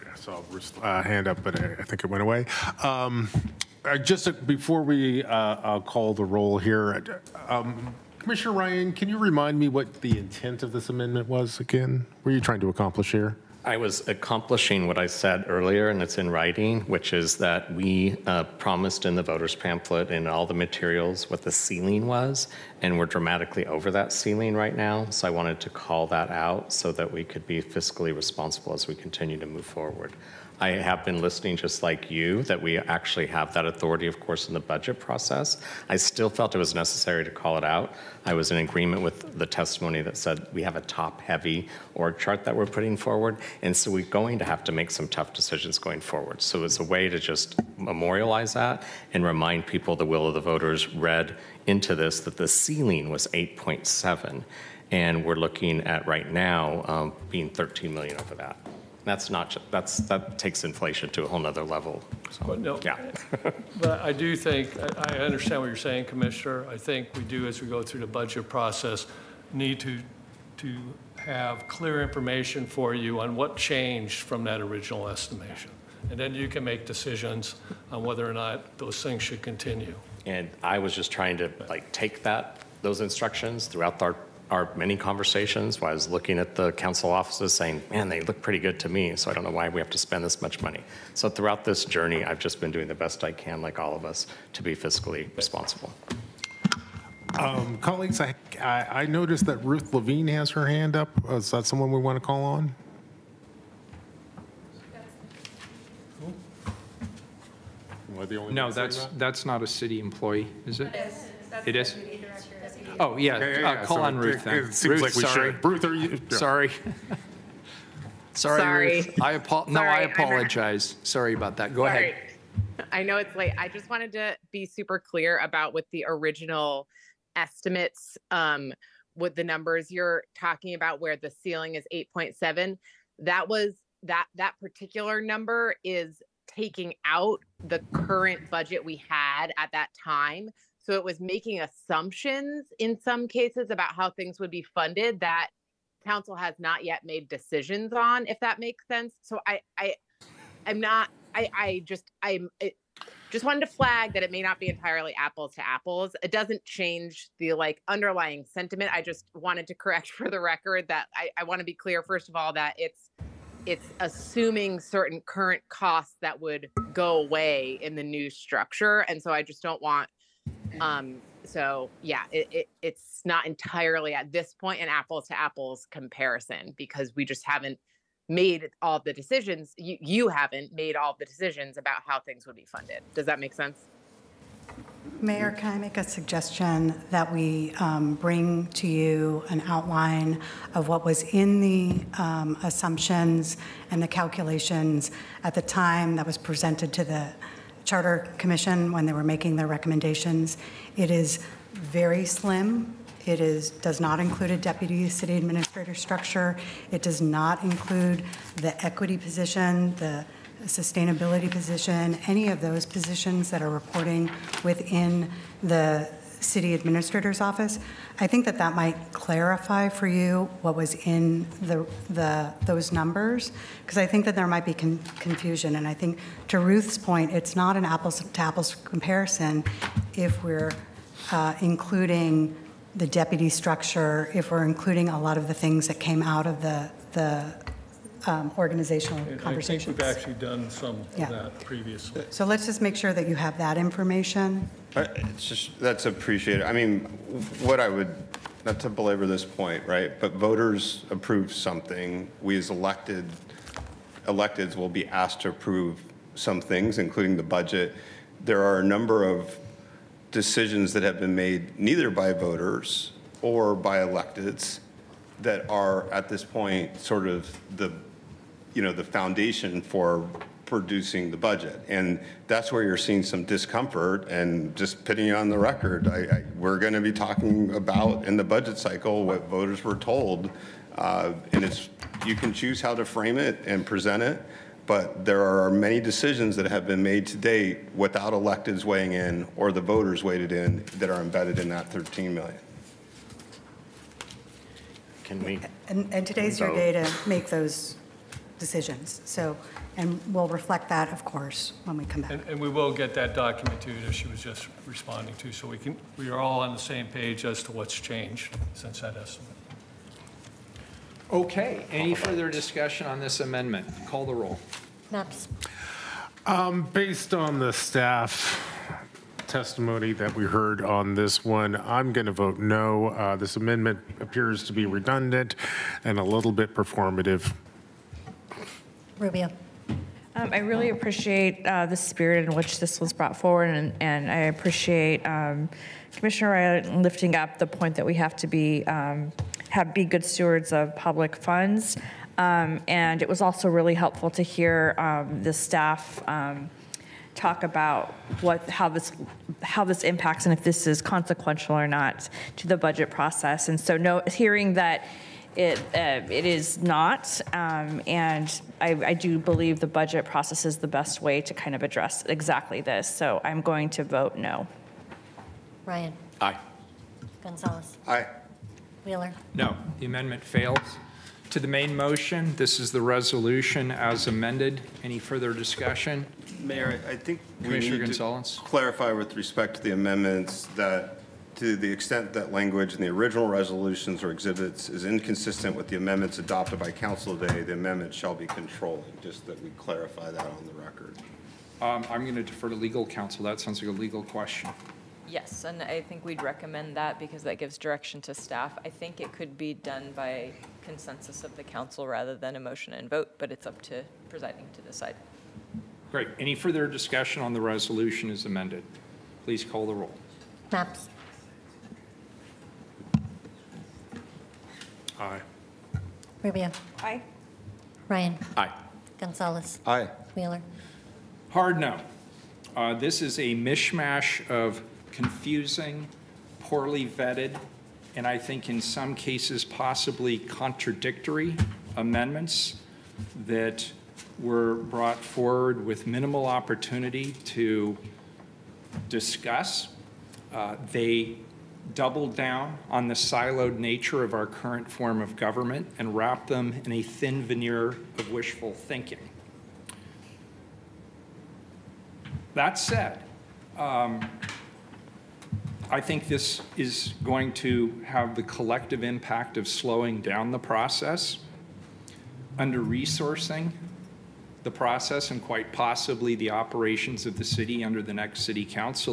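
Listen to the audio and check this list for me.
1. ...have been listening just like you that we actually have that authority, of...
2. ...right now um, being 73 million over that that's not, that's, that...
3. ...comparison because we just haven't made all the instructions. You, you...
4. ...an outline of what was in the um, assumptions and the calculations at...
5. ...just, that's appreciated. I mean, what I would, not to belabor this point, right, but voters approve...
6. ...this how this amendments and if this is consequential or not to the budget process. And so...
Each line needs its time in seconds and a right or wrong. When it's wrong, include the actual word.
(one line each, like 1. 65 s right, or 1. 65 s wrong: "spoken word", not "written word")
1. 30 s right
2. 56 s wrong: "13", not "73"
3. 175 s wrong: "decisions", not "instructions"
4. 189 s right
5. 245 s right
6. 348 s wrong: "impacts", not "amendments".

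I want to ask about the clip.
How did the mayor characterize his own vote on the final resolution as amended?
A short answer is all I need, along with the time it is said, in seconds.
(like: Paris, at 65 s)
Hard no, at 421 s.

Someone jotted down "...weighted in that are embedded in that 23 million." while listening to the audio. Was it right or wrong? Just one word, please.
wrong.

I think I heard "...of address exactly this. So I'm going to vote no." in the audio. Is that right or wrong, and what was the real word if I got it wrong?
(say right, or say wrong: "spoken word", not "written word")
right.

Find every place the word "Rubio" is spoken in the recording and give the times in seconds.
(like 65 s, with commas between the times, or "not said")
329 s, 416 s.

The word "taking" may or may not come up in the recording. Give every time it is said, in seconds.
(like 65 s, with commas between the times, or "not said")
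136 s.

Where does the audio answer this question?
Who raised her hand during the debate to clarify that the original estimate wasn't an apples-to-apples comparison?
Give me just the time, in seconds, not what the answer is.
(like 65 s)
99 s.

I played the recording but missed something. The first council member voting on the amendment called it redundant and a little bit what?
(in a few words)
Performative.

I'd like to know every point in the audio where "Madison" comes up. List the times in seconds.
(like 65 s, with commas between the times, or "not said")
not said.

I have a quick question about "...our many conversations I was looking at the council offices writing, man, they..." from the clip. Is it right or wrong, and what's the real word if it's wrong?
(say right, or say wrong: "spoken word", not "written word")
wrong: "saying", not "writing".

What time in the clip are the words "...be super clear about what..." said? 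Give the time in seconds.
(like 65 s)
124 s.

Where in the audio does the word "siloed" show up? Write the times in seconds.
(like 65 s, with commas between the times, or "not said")
443 s.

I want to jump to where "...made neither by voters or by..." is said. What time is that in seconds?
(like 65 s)
261 s.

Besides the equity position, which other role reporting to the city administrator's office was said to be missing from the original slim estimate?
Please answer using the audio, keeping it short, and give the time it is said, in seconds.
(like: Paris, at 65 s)
Sustainability position, at 209 s.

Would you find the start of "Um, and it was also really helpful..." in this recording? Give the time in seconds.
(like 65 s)
342 s.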